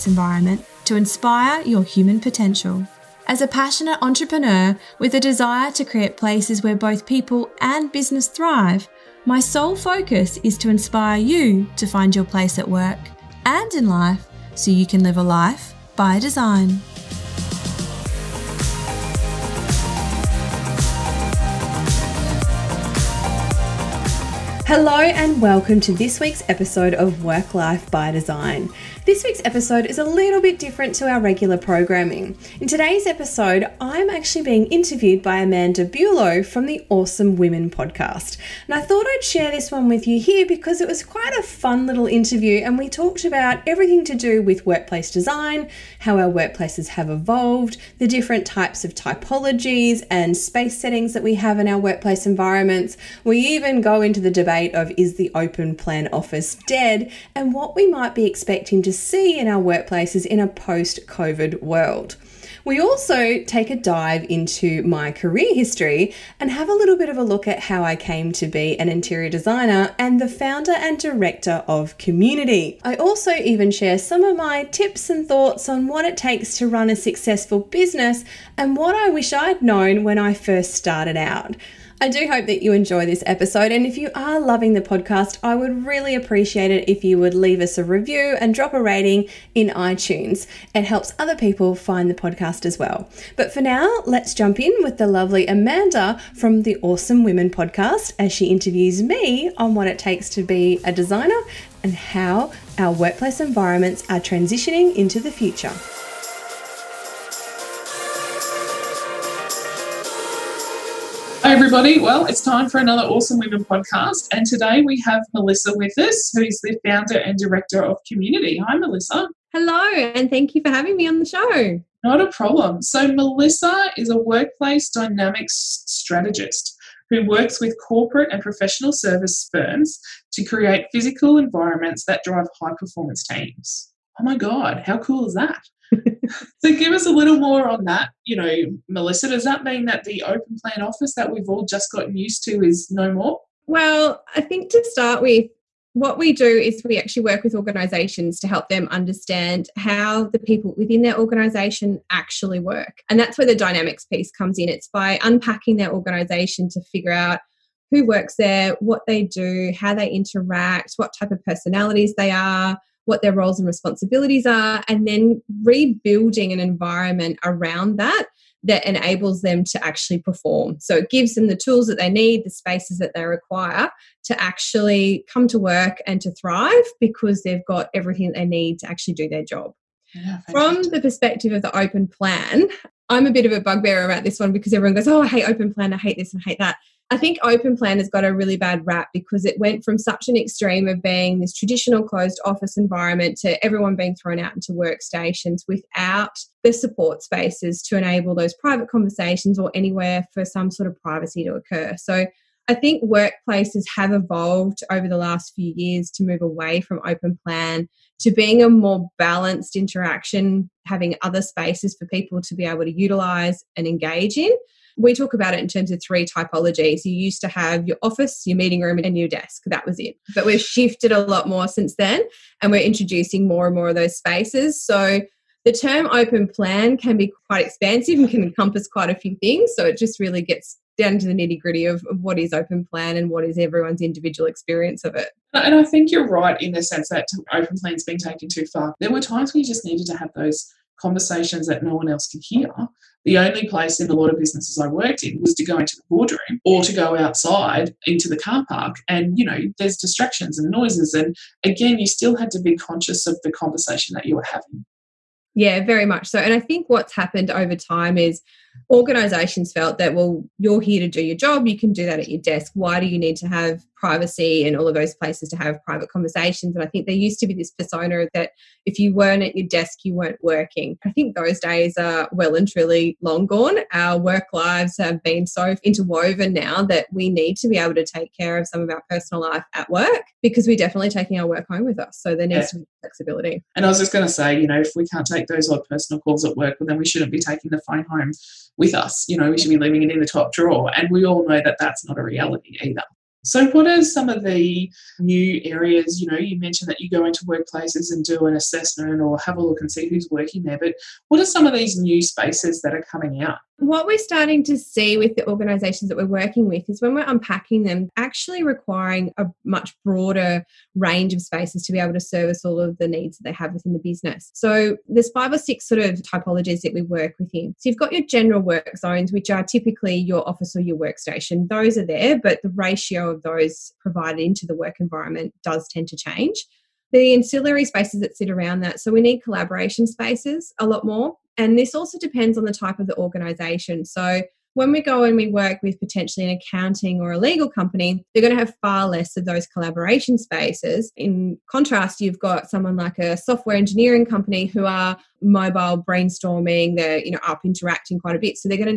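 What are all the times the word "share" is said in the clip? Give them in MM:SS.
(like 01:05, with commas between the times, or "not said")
00:39, 01:13.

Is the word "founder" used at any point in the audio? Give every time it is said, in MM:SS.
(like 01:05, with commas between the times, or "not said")
01:10, 01:56.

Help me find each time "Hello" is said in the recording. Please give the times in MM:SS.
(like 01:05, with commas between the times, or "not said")
00:24, 01:59.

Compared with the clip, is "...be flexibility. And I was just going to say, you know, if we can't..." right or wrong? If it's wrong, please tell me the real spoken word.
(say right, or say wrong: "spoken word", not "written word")
right.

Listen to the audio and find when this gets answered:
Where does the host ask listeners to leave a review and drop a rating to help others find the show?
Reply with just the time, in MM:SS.
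01:29.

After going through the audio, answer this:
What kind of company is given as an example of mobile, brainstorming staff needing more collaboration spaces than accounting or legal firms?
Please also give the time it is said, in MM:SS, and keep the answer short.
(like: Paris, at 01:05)
Software engineering company, at 05:43.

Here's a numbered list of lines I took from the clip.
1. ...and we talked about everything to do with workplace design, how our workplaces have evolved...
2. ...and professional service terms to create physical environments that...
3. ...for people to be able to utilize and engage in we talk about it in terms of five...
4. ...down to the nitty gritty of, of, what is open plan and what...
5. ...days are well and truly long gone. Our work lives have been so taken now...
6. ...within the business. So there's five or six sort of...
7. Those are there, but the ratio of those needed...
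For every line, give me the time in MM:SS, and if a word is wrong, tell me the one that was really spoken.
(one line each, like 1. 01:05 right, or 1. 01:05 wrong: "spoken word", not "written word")
1. 00:42 right
2. 02:08 wrong: "firms", not "terms"
3. 03:31 wrong: "three", not "five"
4. 03:50 right
5. 04:31 wrong: "interwoven", not "taken"
6. 05:13 right
7. 05:21 wrong: "provided", not "needed".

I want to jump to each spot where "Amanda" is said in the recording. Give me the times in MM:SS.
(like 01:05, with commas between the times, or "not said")
00:35, 01:35.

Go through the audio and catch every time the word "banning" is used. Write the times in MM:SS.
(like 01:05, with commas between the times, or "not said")
not said.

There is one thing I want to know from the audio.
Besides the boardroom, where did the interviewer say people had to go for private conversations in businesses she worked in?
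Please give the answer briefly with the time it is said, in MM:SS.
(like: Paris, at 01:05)
The car park, at 04:08.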